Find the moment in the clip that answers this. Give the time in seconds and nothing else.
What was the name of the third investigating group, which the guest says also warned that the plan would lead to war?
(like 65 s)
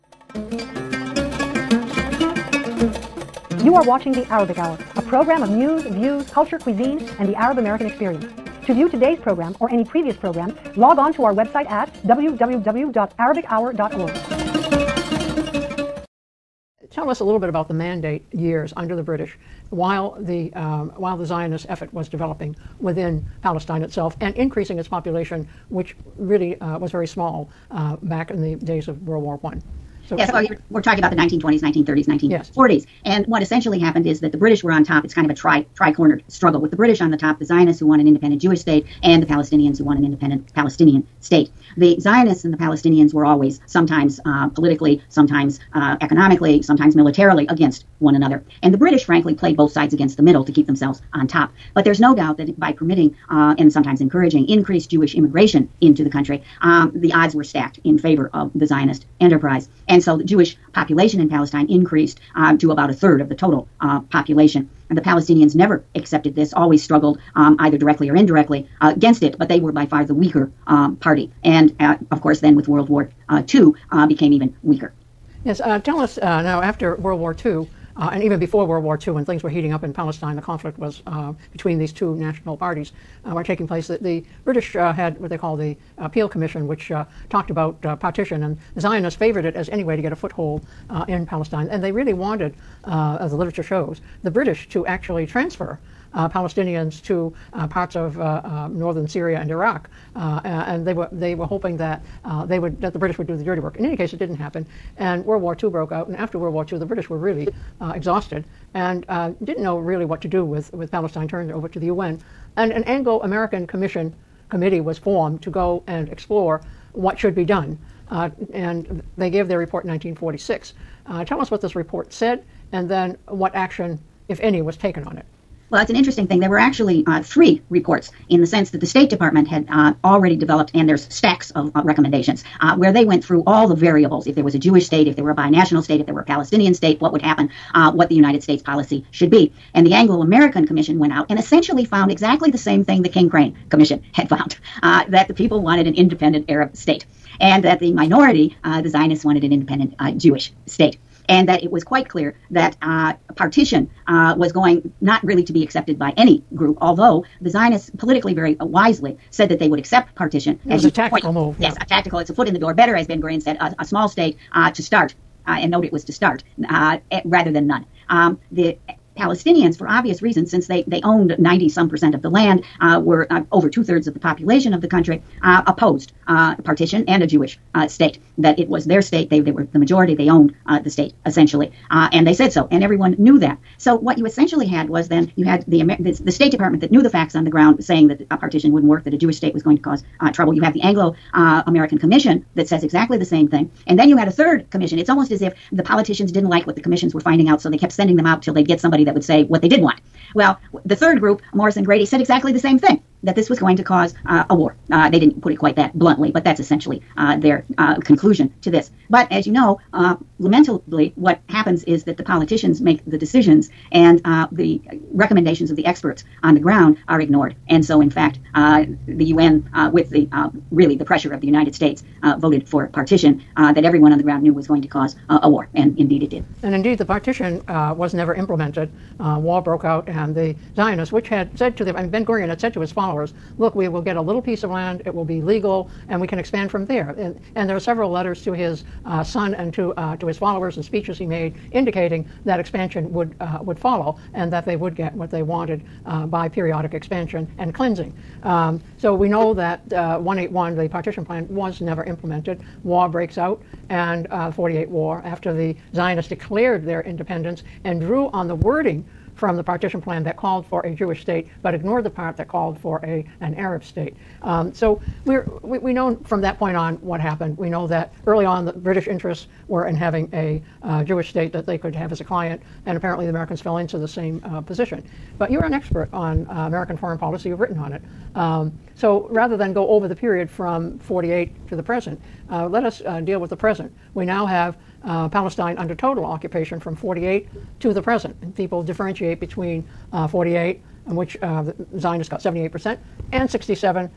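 201 s.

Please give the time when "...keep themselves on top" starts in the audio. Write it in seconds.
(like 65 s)
50 s.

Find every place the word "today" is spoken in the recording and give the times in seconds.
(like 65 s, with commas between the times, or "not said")
8 s.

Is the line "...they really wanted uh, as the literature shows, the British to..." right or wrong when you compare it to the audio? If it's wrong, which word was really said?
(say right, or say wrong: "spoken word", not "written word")
right.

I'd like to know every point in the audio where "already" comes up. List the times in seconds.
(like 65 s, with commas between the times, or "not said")
130 s.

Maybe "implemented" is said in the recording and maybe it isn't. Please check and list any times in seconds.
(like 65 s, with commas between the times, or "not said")
228 s, 252 s.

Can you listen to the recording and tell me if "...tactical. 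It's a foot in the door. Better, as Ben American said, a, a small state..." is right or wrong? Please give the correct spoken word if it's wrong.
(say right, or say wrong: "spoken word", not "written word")
wrong: "Gurion", not "American".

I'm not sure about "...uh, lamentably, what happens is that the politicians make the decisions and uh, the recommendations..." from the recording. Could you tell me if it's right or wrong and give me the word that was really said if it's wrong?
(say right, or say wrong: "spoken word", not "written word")
right.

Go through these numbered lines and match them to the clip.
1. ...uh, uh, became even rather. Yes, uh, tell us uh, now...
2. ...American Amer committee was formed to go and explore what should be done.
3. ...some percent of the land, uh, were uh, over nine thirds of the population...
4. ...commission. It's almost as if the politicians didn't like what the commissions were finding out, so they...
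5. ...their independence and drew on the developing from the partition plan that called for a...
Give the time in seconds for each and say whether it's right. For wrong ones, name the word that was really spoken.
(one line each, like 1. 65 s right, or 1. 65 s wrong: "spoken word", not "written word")
1. 73 s wrong: "weaker", not "rather"
2. 113 s wrong: "Commission", not "Amer"
3. 171 s wrong: "two", not "nine"
4. 194 s right
5. 256 s wrong: "wording", not "developing".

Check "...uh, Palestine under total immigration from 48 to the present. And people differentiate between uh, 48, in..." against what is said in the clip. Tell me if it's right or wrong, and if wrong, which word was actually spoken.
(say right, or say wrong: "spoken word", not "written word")
wrong: "occupation", not "immigration".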